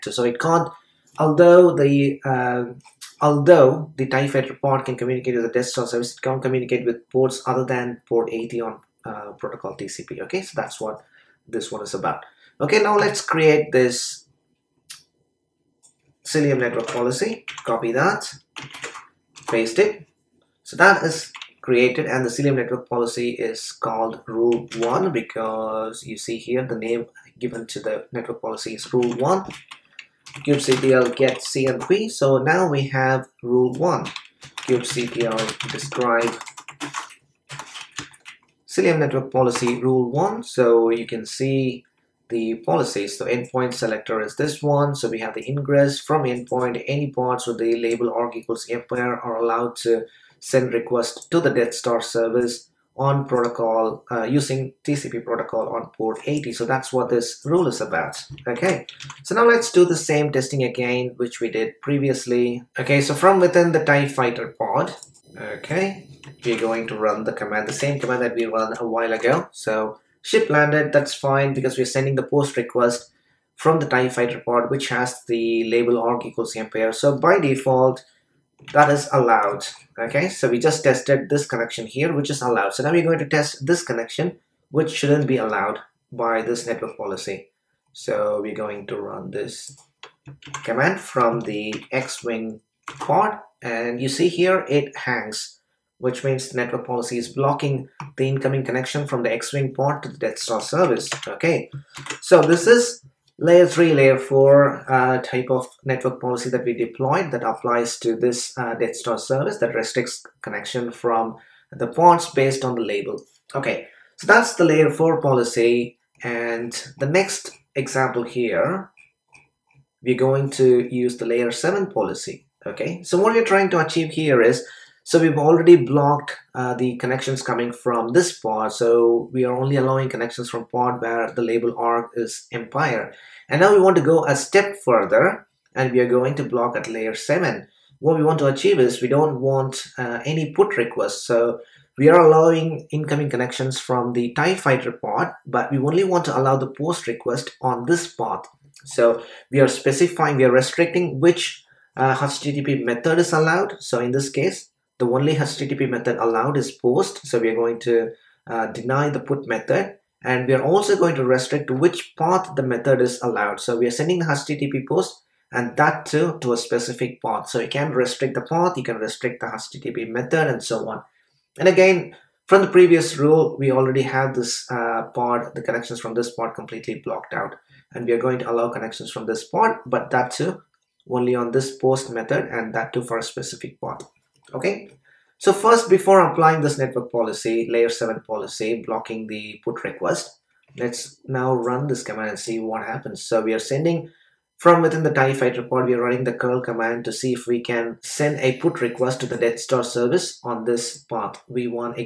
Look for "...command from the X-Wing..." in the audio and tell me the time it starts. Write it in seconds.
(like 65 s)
90 s.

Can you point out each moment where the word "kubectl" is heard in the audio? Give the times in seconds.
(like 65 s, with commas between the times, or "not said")
30 s, 34 s.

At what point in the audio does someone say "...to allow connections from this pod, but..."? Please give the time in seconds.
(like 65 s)
178 s.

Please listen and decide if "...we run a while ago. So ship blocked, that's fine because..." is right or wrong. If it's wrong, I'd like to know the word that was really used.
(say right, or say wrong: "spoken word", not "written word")
wrong: "landed", not "blocked".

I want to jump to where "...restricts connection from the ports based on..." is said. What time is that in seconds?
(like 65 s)
109 s.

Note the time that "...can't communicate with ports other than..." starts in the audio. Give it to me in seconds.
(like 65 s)
6 s.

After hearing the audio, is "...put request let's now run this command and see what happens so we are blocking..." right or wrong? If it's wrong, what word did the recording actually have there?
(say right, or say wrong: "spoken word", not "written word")
wrong: "sending", not "blocking".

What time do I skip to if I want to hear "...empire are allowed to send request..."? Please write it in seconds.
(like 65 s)
48 s.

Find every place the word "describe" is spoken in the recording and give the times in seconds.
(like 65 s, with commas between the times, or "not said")
35 s.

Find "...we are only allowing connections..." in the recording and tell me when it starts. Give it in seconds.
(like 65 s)
129 s.